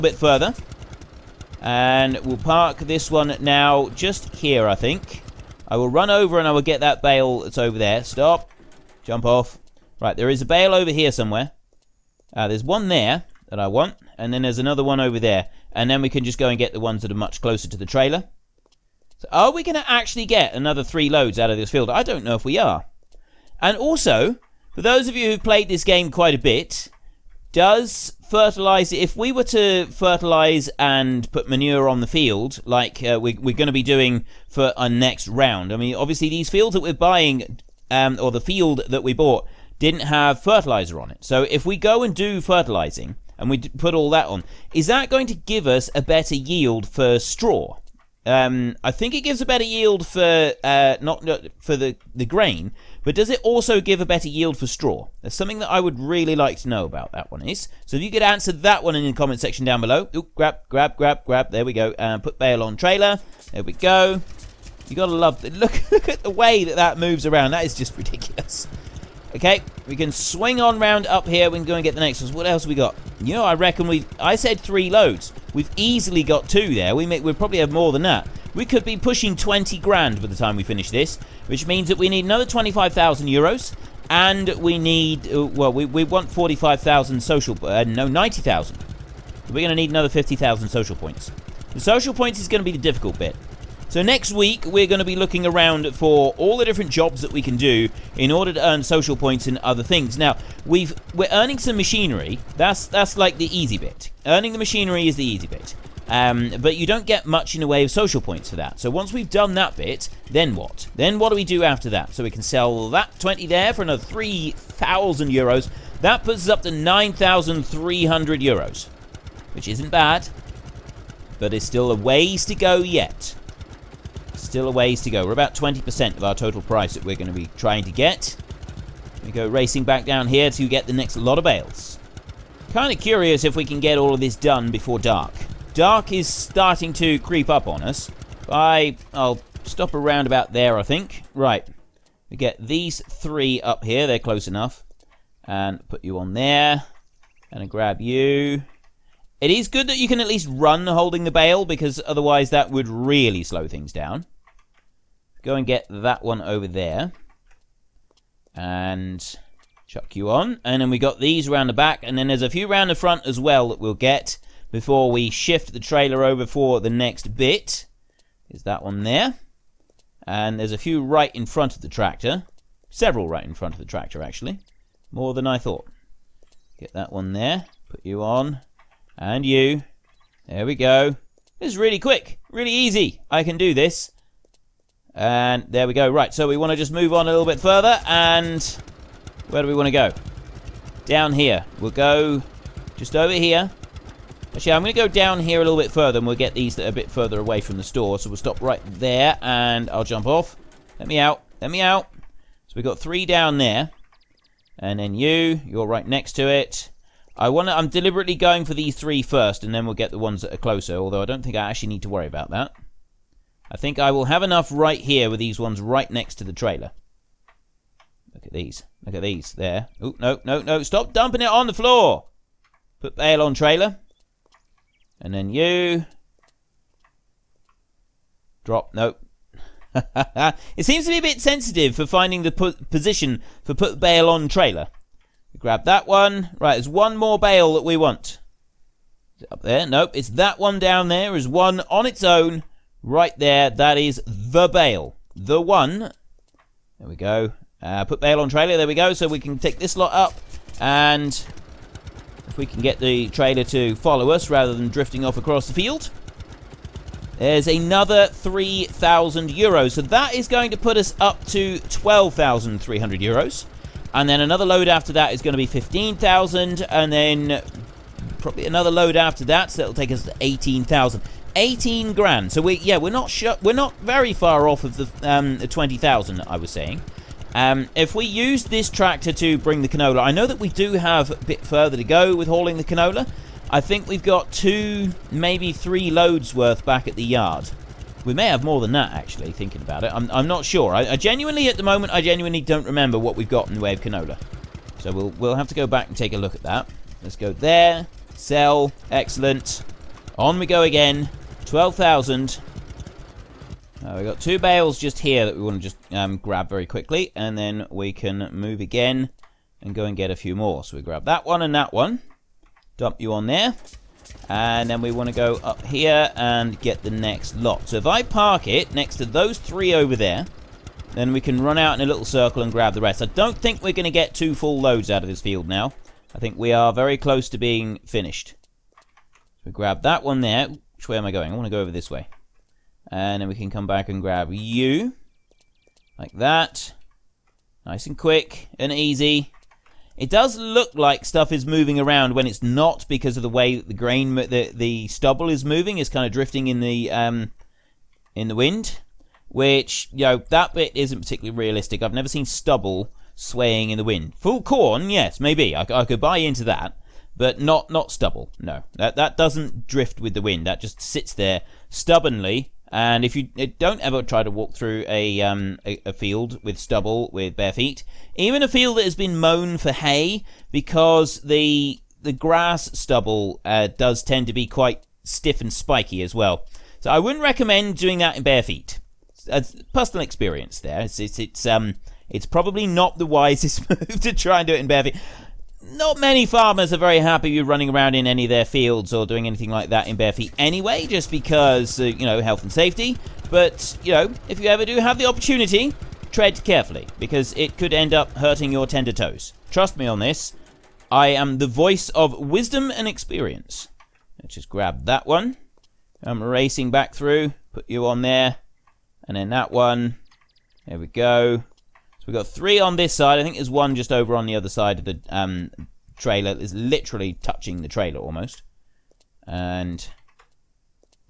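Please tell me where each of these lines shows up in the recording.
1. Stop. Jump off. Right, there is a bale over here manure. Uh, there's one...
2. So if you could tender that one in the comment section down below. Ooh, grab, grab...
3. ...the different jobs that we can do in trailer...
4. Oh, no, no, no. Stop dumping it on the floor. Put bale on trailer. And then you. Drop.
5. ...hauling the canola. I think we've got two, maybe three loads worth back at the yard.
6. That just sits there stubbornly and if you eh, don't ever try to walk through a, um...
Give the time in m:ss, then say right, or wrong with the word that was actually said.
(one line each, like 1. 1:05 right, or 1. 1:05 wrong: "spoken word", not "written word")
1. 0:08 wrong: "somewhere", not "manure"
2. 0:57 wrong: "answer", not "tender"
3. 1:36 wrong: "order", not "trailer"
4. 3:39 right
5. 4:42 right
6. 6:00 right.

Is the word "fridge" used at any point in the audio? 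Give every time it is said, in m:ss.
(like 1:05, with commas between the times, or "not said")
not said.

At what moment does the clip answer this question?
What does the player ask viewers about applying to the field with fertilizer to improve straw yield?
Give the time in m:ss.
0:31.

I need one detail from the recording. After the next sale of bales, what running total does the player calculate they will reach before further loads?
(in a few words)
12,300 euros.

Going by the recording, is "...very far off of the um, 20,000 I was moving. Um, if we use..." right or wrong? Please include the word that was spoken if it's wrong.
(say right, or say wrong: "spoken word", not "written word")
wrong: "saying", not "moving".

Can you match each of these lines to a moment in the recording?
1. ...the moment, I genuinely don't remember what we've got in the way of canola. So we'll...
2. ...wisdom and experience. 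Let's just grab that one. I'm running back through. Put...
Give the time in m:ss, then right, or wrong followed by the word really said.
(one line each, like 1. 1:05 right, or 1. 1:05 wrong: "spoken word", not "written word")
1. 4:51 right
2. 6:42 wrong: "racing", not "running".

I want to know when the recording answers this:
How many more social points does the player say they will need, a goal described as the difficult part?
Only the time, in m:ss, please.
1:29.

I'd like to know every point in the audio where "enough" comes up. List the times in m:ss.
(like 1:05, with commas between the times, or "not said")
2:24, 3:34.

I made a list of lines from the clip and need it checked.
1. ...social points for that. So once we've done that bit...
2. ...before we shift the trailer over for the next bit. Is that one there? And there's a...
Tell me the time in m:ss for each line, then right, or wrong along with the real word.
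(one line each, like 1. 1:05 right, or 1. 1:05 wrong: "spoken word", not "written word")
1. 1:47 right
2. 2:44 right.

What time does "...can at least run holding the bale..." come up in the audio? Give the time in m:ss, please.
2:30.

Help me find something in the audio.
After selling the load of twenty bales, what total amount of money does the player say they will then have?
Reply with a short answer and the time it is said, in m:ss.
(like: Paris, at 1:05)
9,300 euros, at 1:56.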